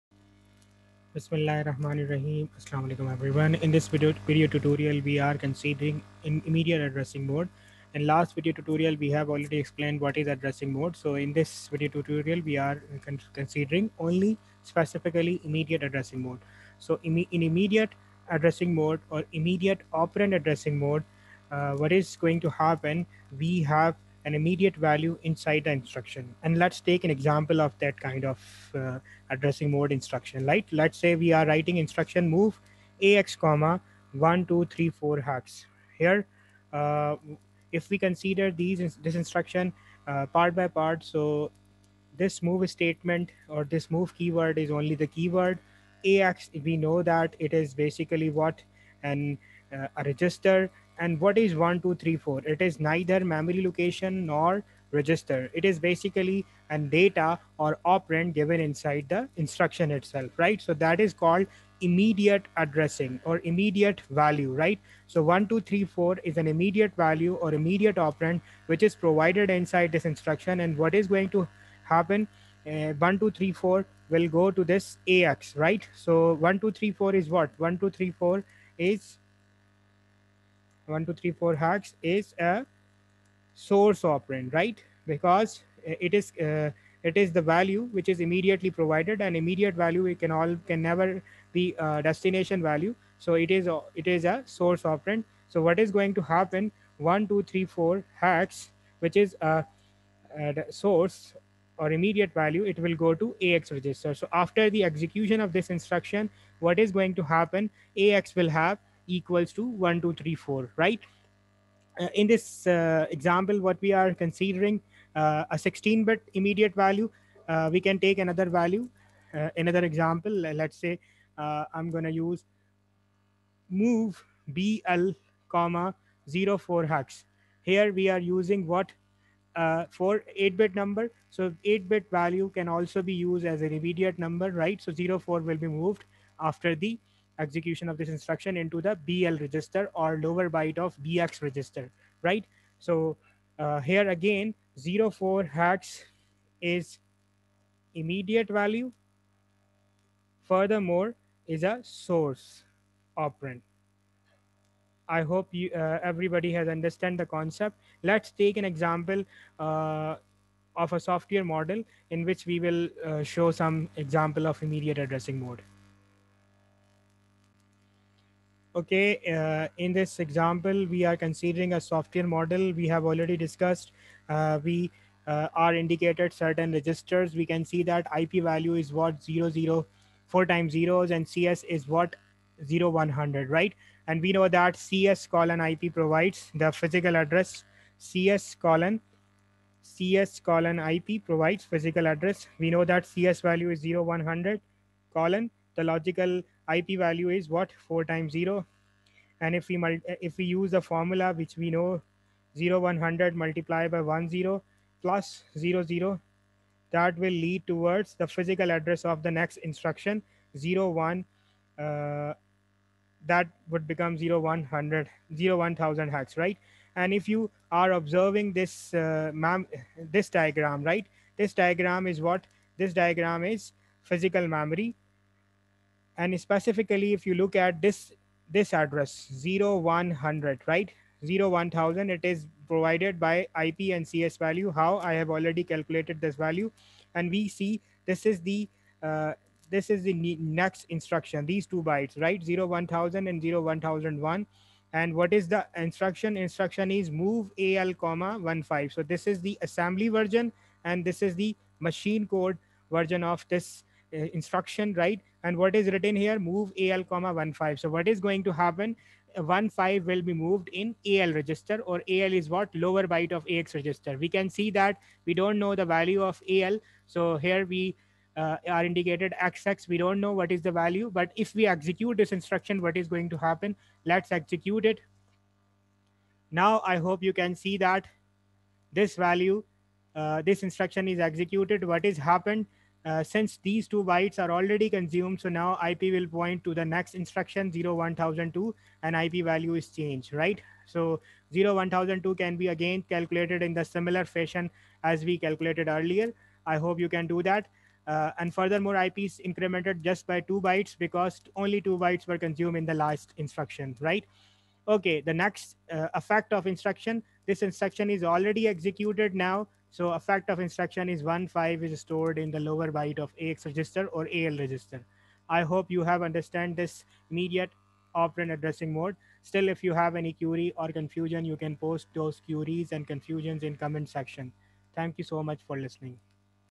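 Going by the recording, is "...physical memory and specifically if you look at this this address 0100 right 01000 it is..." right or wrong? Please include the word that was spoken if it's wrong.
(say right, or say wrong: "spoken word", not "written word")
right.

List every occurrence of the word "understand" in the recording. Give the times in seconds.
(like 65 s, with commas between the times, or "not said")
156 s, 316 s.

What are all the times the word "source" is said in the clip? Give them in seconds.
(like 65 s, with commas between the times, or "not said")
83 s, 94 s, 100 s, 151 s.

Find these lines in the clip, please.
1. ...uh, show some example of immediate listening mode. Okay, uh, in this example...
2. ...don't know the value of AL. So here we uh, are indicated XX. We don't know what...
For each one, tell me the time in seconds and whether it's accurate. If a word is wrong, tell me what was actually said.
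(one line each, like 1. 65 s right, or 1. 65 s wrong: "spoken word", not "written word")
1. 163 s wrong: "addressing", not "listening"
2. 265 s right.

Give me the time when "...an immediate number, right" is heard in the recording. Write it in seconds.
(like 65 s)
133 s.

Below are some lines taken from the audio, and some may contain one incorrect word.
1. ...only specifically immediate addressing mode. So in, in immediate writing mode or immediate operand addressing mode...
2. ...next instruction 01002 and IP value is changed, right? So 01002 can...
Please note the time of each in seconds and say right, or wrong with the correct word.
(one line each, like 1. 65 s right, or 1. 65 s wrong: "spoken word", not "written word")
1. 13 s wrong: "addressing", not "writing"
2. 286 s right.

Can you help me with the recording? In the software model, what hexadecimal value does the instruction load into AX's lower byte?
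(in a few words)
15.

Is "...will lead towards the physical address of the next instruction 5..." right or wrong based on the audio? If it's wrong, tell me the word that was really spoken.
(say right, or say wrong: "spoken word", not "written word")
wrong: "0", not "5".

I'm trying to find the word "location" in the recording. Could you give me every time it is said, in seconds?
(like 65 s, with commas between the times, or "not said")
53 s.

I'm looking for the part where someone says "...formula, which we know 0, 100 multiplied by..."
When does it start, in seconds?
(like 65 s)
200 s.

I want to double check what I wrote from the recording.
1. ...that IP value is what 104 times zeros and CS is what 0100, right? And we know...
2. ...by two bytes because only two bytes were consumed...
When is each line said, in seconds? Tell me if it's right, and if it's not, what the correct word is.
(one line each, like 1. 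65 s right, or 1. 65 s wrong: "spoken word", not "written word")
1. 177 s wrong: "004", not "104"
2. 300 s right.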